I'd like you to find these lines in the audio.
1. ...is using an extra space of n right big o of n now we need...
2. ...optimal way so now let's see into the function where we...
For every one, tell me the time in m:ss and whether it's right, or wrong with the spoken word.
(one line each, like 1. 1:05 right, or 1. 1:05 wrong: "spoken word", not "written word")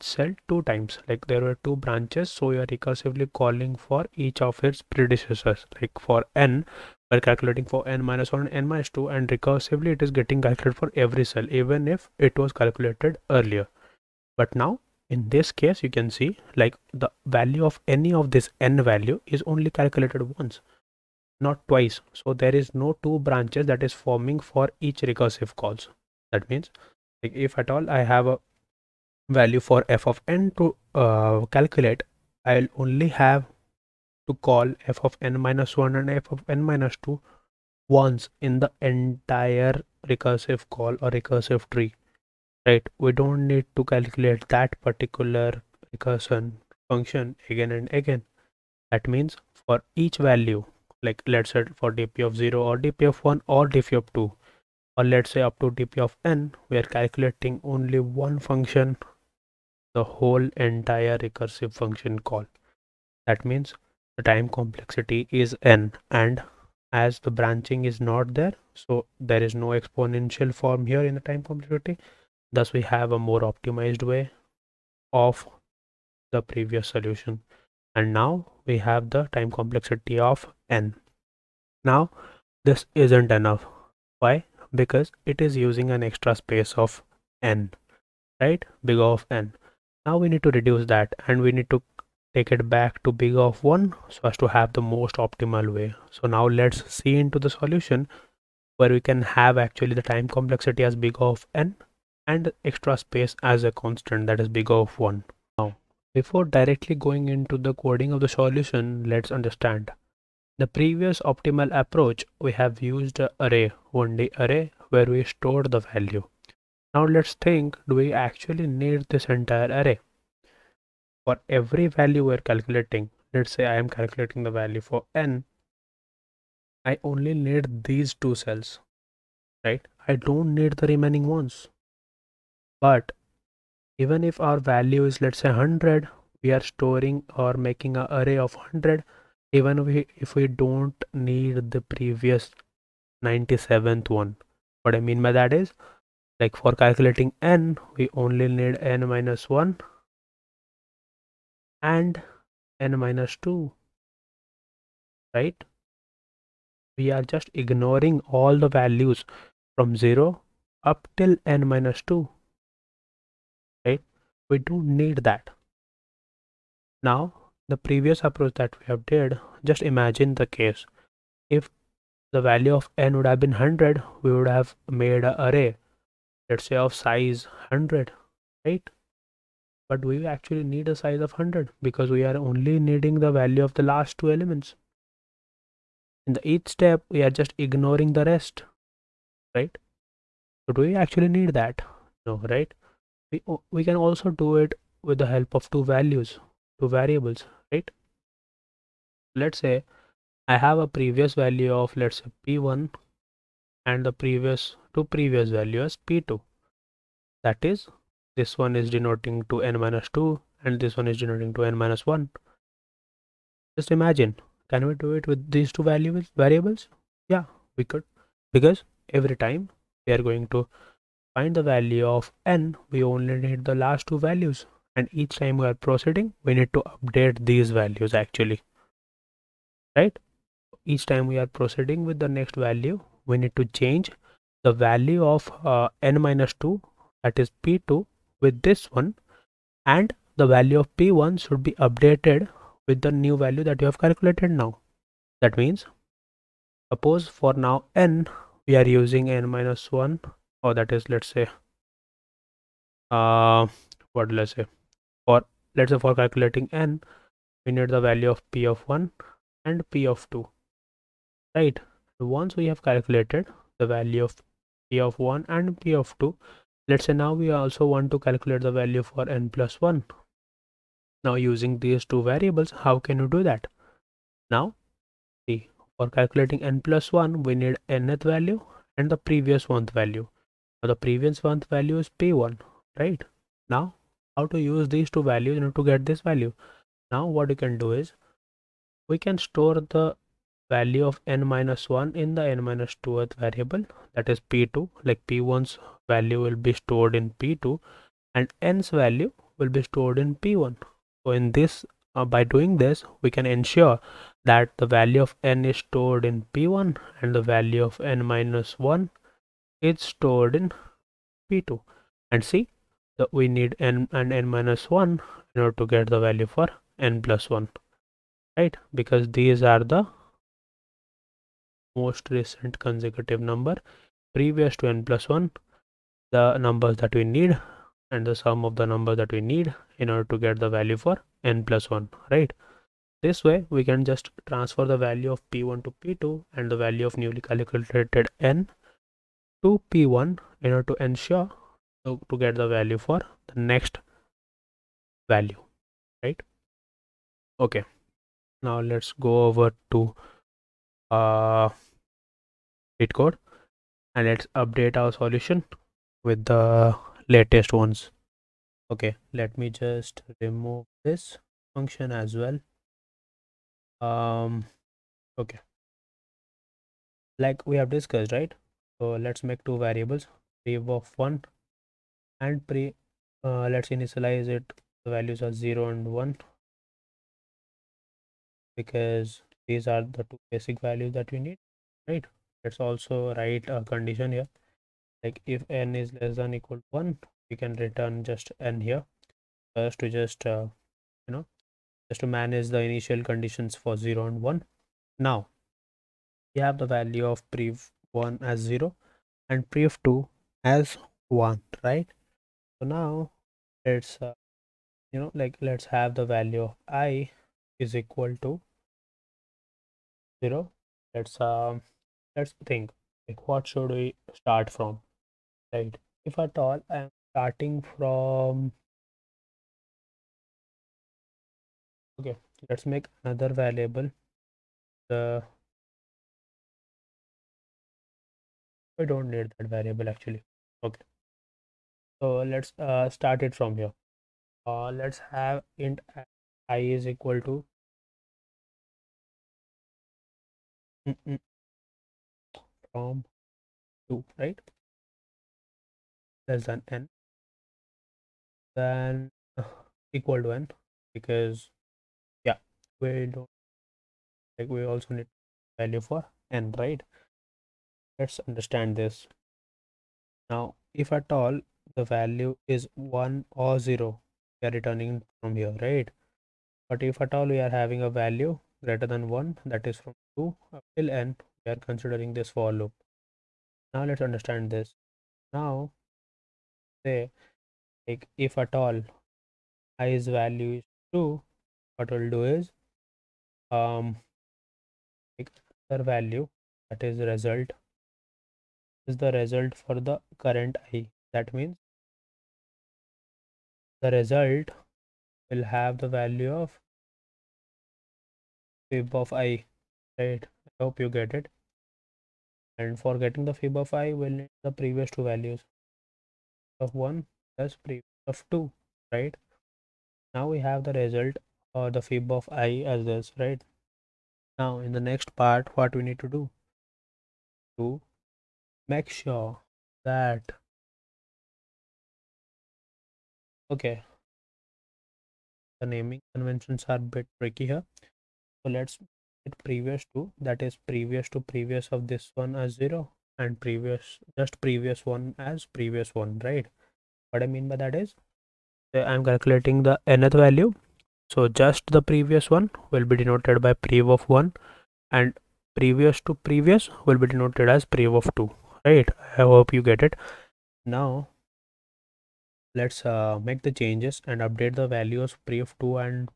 1. 1:25 right
2. 1:35 wrong: "solution", not "function".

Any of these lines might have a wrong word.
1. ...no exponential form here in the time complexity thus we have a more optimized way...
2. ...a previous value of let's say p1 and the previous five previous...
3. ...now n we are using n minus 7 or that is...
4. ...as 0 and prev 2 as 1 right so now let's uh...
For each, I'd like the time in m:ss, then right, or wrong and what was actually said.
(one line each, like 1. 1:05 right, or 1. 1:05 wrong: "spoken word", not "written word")
1. 1:09 right
2. 3:20 wrong: "two", not "five"
3. 4:07 wrong: "1", not "7"
4. 6:38 right.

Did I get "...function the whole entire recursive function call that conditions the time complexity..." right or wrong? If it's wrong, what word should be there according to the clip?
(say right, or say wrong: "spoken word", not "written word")
wrong: "means", not "conditions".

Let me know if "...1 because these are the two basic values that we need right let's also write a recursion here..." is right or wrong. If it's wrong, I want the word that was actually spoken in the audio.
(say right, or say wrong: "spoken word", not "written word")
wrong: "condition", not "recursion".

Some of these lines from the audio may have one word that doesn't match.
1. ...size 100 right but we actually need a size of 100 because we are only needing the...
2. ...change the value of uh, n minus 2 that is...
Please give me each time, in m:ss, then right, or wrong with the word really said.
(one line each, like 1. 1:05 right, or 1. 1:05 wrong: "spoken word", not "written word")
1. 2:57 right
2. 3:53 right.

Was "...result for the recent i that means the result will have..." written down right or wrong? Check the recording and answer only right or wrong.
wrong.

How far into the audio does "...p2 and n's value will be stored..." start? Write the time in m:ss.
4:57.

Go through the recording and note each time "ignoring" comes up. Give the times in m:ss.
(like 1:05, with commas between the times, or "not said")
2:37, 3:07.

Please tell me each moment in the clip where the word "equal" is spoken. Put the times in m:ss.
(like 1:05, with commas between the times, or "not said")
6:26, 6:48, 7:17, 7:30.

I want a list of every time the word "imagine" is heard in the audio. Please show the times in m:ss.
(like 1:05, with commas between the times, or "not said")
2:49, 3:33.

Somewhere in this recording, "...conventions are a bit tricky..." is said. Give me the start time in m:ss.
8:46.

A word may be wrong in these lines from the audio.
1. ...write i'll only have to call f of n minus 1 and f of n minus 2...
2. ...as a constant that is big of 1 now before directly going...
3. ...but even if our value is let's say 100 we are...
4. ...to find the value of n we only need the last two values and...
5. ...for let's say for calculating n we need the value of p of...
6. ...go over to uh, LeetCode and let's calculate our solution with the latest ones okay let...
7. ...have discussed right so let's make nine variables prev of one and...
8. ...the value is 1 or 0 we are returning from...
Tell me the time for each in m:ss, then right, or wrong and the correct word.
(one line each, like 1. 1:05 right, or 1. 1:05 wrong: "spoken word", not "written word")
1. 0:31 wrong: "calculate", not "write"
2. 1:43 right
3. 2:12 right
4. 3:40 right
5. 4:15 right
6. 5:49 wrong: "update", not "calculate"
7. 6:07 wrong: "two", not "nine"
8. 7:41 right.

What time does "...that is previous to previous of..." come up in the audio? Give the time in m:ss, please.
8:50.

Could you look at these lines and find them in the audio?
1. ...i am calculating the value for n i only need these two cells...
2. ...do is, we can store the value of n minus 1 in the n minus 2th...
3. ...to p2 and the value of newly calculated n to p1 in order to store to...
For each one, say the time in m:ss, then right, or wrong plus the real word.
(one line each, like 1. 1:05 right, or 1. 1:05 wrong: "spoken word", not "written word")
1. 2:03 right
2. 4:47 right
3. 5:35 wrong: "ensure", not "store".